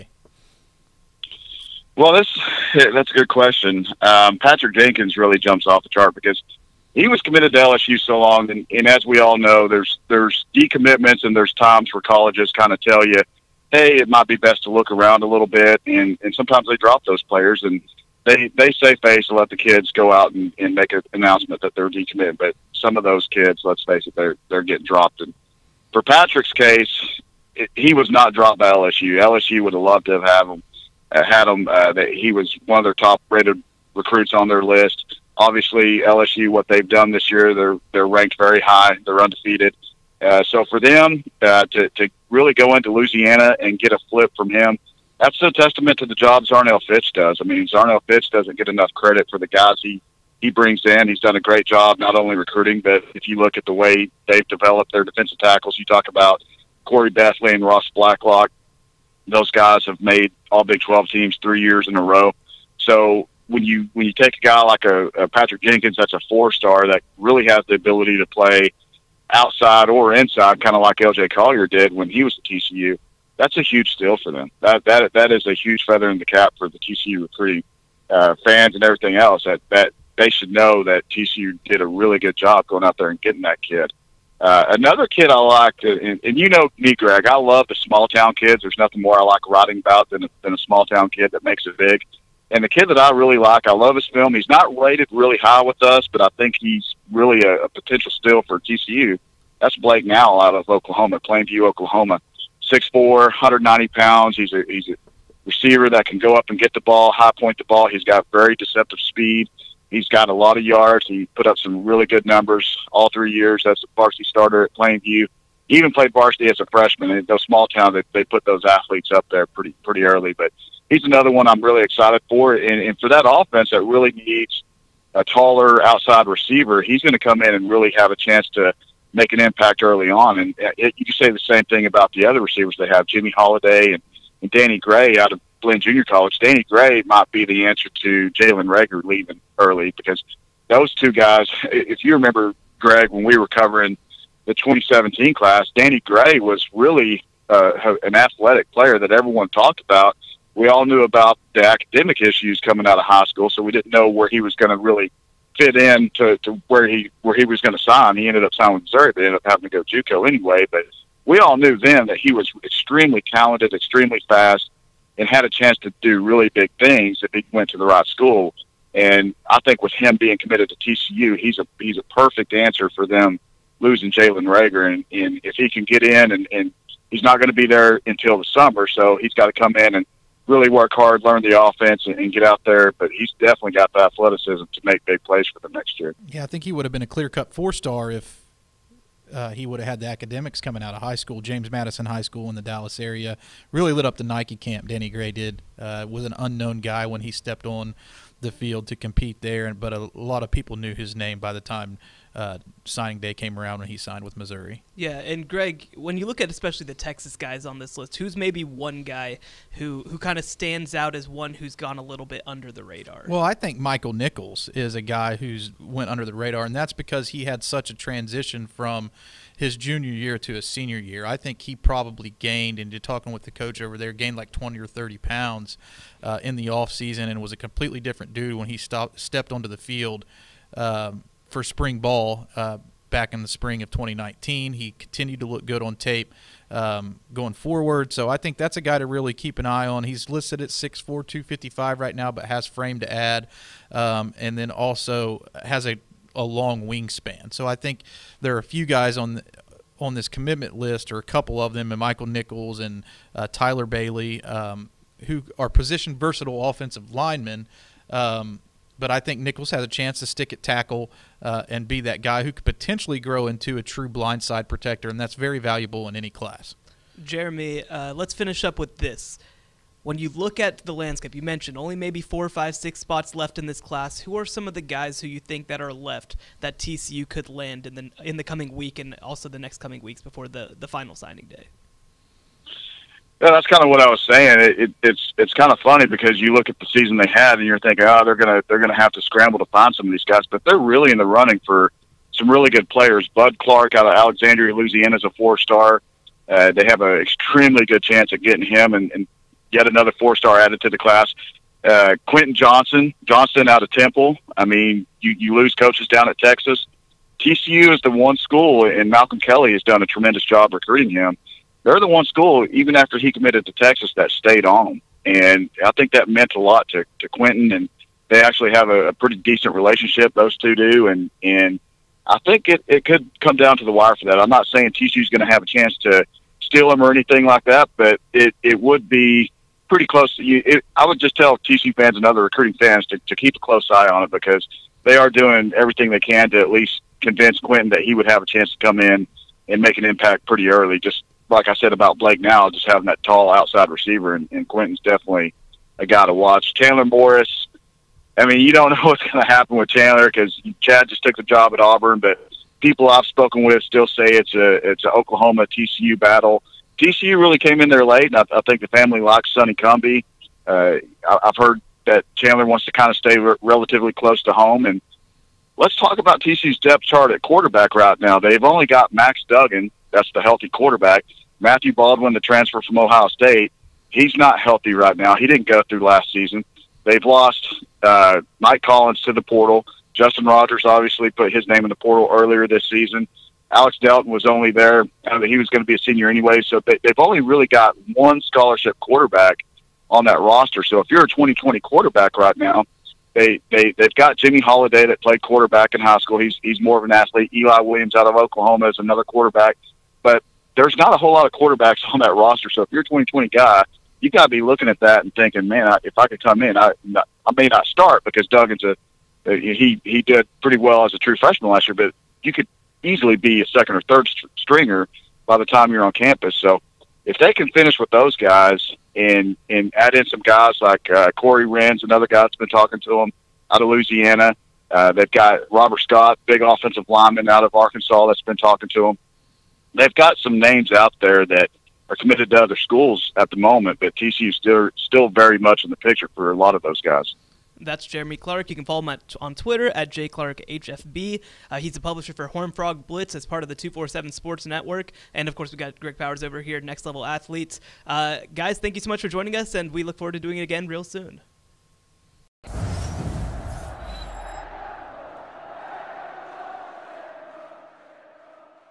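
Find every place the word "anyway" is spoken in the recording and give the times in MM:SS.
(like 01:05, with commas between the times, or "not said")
02:40, 06:26.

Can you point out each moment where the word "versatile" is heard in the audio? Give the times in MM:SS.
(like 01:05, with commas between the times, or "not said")
04:16.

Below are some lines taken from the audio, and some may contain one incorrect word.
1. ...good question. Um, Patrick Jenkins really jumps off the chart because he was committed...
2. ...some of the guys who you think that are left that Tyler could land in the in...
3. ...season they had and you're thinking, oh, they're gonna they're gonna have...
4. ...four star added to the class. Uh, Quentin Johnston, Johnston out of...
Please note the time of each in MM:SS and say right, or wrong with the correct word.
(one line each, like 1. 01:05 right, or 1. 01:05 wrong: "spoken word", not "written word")
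1. 00:03 right
2. 04:34 wrong: "TCU", not "Tyler"
3. 04:46 right
4. 05:00 right.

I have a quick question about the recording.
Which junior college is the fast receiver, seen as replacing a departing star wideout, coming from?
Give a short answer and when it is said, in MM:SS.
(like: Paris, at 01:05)
Blinn Junior College, at 02:15.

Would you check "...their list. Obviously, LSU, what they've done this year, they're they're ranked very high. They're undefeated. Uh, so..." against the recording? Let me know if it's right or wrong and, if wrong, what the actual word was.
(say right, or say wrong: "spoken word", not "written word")
right.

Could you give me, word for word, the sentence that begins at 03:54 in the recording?
He continued to look good on tape um, going forward.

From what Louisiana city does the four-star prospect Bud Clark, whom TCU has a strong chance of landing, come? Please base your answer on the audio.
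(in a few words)
Alexandria.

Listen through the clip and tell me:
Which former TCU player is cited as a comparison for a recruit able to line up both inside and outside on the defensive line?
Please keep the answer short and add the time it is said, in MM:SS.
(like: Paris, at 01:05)
LJ Collier, at 01:10.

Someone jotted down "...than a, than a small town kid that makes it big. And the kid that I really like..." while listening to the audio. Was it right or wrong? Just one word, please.
right.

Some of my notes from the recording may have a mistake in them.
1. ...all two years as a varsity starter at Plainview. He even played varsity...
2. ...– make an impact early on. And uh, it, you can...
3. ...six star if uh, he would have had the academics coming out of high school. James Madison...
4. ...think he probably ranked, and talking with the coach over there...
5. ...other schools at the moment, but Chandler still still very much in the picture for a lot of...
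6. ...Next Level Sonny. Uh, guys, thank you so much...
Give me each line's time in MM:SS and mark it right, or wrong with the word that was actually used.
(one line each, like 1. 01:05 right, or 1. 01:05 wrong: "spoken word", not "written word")
1. 01:52 wrong: "three", not "two"
2. 02:08 right
3. 03:07 wrong: "four", not "six"
4. 03:41 wrong: "gained", not "ranked"
5. 07:12 wrong: "TCU", not "Chandler"
6. 07:26 wrong: "Athletes", not "Sonny".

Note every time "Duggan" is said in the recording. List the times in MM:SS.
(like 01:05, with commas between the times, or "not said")
06:09, 06:48.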